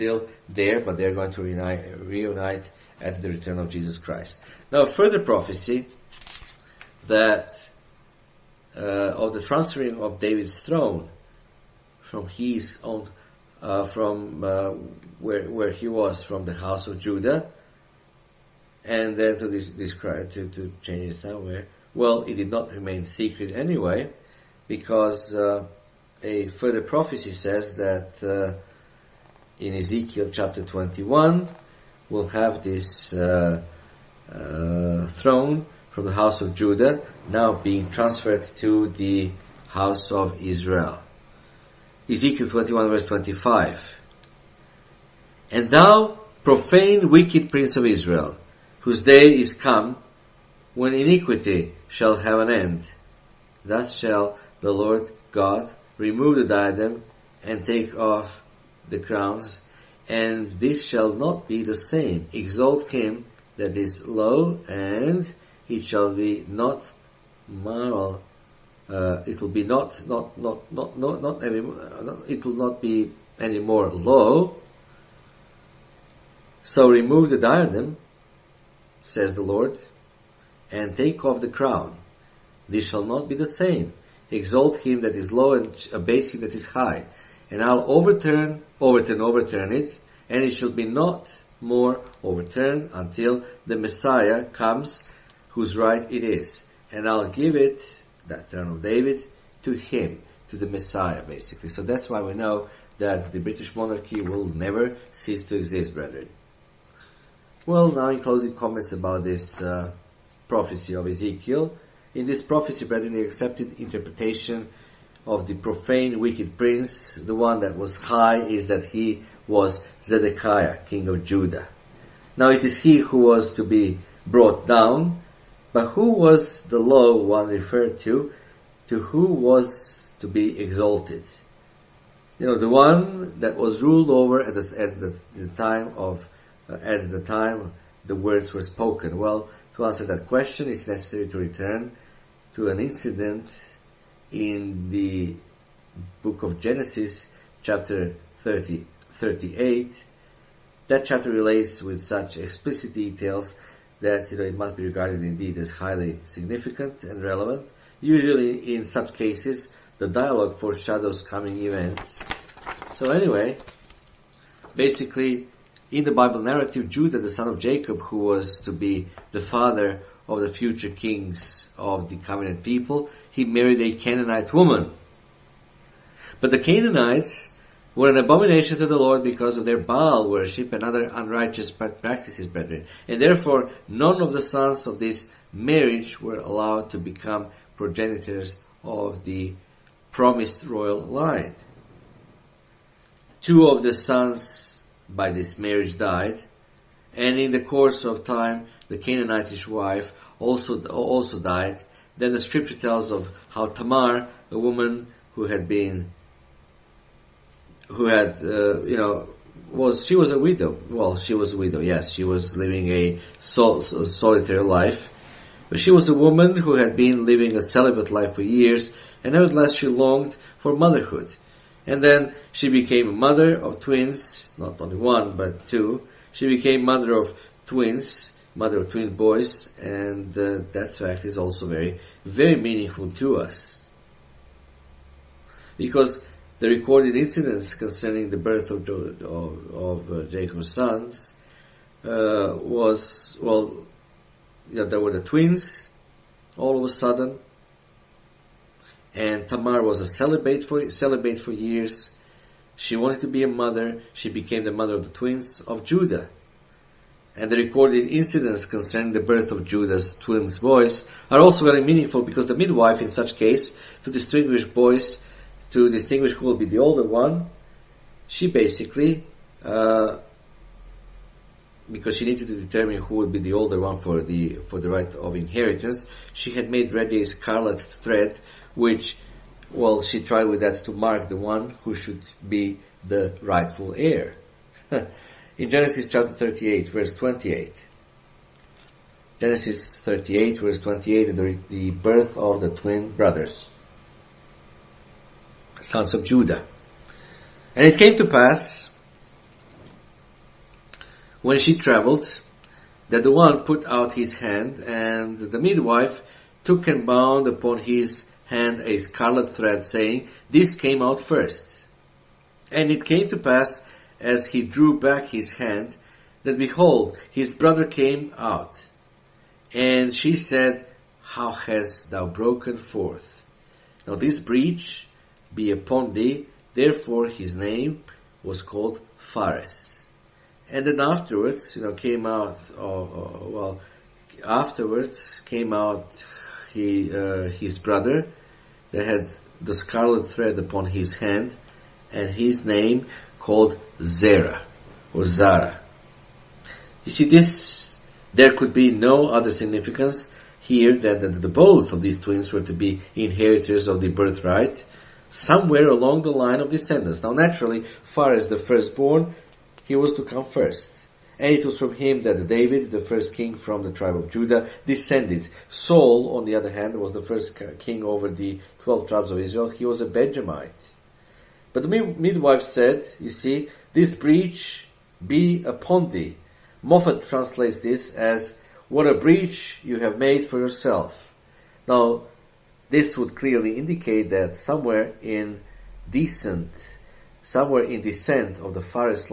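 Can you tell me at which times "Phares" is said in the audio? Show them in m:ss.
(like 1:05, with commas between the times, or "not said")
5:29, 5:58, 6:28.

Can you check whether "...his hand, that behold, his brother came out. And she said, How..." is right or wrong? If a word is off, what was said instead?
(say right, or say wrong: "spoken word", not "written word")
right.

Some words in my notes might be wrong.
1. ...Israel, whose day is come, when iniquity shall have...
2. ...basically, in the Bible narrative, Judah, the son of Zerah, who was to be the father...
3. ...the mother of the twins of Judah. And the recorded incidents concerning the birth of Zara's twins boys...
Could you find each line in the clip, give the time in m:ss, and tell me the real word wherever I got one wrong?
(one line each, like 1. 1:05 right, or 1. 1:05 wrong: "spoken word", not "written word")
1. 0:47 right
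2. 2:44 wrong: "Jacob", not "Zerah"
3. 4:14 wrong: "Judah", not "Zara".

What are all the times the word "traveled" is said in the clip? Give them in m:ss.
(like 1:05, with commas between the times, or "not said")
5:01.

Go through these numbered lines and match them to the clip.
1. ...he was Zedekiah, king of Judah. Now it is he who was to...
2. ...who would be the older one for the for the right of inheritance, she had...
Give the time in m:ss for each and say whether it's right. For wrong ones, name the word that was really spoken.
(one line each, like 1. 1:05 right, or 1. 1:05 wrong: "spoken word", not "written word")
1. 1:58 right
2. 4:33 right.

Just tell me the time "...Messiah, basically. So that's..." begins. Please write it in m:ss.
1:40.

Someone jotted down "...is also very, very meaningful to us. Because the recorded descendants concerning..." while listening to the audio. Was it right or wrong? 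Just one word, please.
wrong.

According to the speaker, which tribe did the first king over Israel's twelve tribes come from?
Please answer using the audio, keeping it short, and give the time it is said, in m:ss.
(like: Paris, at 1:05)
Benjamite, at 6:10.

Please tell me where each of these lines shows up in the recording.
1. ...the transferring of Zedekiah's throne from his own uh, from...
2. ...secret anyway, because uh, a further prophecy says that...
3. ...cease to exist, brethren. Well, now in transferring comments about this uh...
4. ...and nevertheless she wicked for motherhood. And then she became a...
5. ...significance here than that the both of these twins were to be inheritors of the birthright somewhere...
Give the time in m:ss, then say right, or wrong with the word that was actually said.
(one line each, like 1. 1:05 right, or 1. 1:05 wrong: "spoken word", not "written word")
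1. 0:09 wrong: "David", not "Zedekiah"
2. 0:23 right
3. 1:45 wrong: "closing", not "transferring"
4. 3:39 wrong: "longed", not "wicked"
5. 5:49 right.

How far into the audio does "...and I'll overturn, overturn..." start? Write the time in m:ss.
1:27.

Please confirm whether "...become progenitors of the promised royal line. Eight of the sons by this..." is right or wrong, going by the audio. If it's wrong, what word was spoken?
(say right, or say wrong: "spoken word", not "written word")
wrong: "Two", not "Eight".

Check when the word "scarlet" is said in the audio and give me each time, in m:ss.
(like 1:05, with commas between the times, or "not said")
4:37, 5:08, 5:39.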